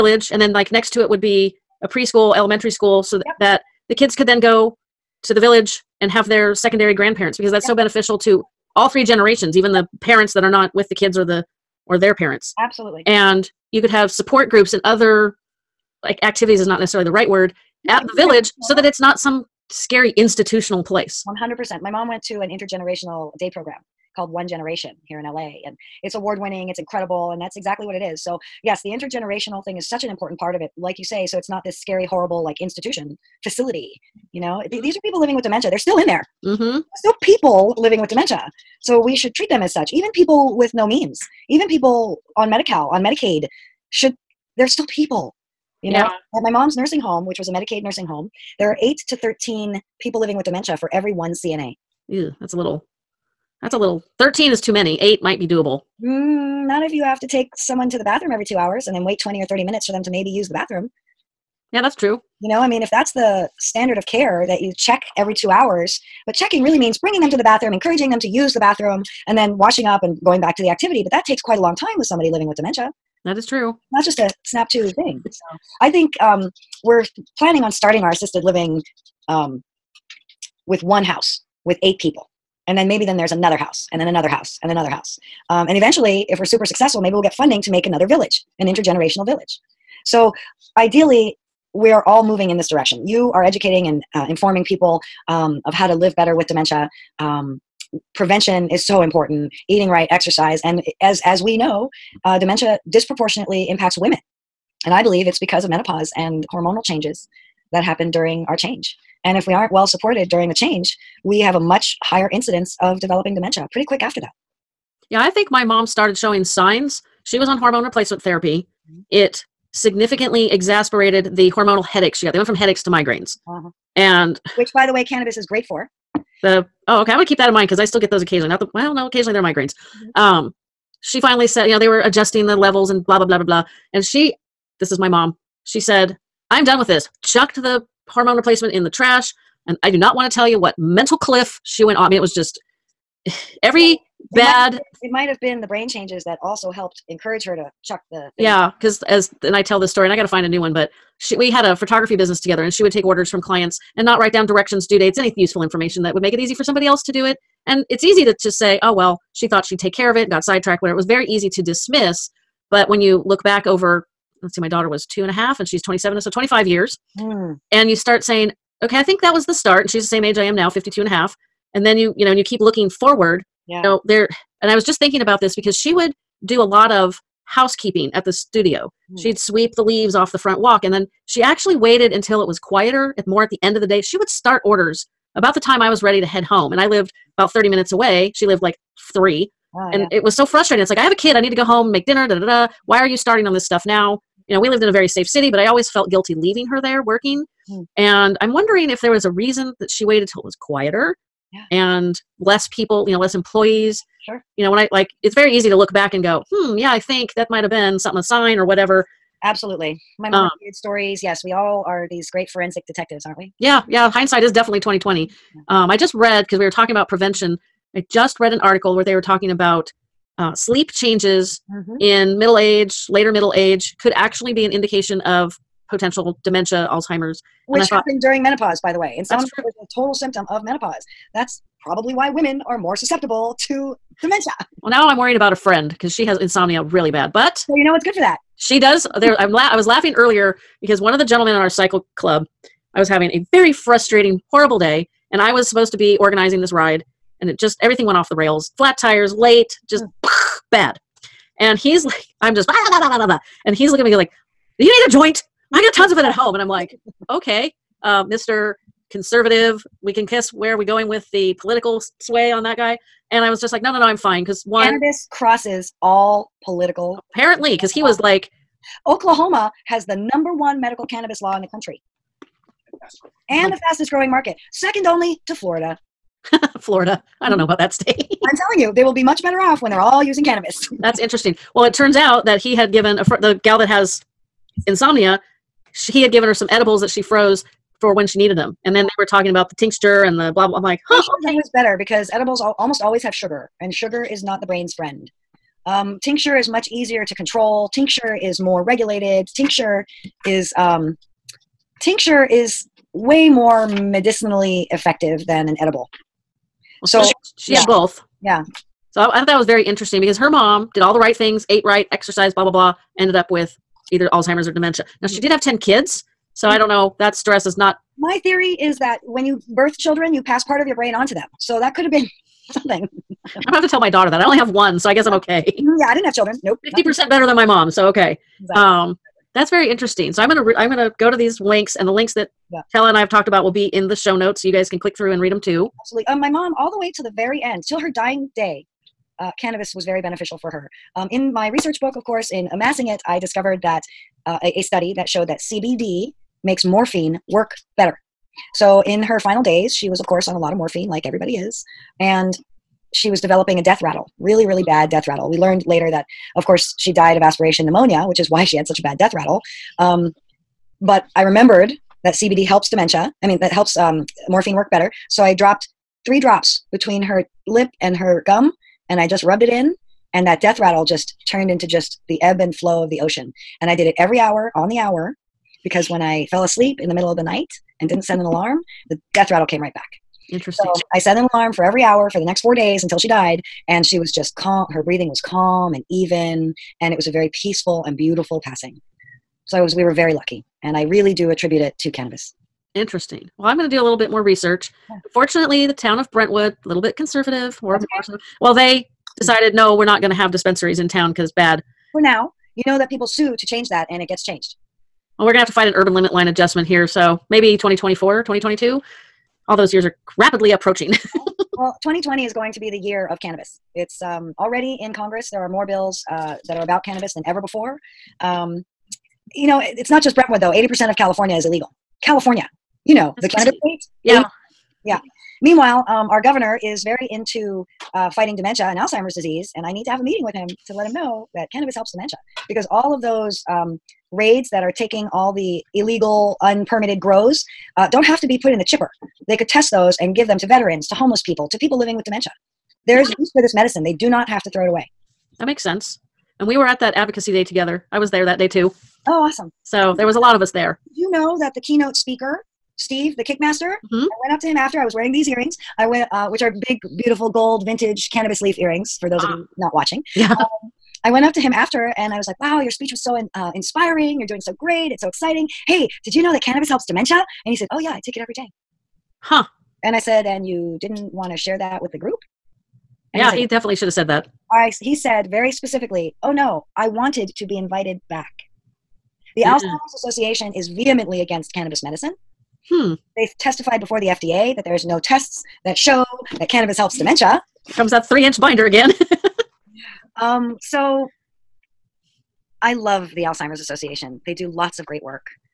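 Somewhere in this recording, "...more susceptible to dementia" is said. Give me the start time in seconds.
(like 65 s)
232 s.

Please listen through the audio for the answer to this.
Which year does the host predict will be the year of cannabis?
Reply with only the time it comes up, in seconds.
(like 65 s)
412 s.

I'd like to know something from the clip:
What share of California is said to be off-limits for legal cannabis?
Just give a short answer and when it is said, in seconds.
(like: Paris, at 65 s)
80%, at 420 s.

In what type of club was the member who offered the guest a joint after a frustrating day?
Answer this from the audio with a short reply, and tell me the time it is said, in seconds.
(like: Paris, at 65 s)
Cycle club, at 241 s.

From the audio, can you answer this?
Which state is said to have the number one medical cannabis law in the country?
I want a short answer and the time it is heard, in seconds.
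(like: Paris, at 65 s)
Oklahoma, at 269 s.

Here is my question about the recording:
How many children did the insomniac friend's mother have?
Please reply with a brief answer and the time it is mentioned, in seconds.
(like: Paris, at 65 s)
10, at 315 s.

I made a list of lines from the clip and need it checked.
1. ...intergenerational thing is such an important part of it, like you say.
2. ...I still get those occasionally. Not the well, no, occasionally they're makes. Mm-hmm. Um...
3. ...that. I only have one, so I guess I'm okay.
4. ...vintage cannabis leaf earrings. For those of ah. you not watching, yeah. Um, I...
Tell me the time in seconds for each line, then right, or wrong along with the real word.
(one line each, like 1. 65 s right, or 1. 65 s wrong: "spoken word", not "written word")
1. 28 s right
2. 127 s wrong: "migraines", not "makes"
3. 324 s right
4. 457 s right.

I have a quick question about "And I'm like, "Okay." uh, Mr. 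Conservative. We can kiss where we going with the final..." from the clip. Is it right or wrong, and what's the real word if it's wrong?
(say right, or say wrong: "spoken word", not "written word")
wrong: "political", not "final".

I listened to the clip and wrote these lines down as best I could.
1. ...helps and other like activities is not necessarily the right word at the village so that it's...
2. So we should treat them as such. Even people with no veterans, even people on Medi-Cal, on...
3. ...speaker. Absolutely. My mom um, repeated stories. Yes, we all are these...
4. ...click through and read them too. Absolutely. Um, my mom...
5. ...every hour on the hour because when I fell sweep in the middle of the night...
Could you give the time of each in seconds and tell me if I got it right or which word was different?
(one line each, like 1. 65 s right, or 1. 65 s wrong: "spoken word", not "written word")
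1. 14 s wrong: "groups", not "helps"
2. 38 s wrong: "means", not "veterans"
3. 208 s wrong: "whatever", not "speaker"
4. 334 s right
5. 374 s wrong: "asleep", not "sweep".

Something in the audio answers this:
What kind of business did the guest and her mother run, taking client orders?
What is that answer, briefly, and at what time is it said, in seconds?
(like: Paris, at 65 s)
Photography, at 151 s.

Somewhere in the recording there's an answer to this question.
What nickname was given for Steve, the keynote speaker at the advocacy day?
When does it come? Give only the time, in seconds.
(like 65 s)
453 s.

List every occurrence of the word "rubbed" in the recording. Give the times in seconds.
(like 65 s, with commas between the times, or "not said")
369 s.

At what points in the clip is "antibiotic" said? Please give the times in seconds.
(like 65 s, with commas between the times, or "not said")
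not said.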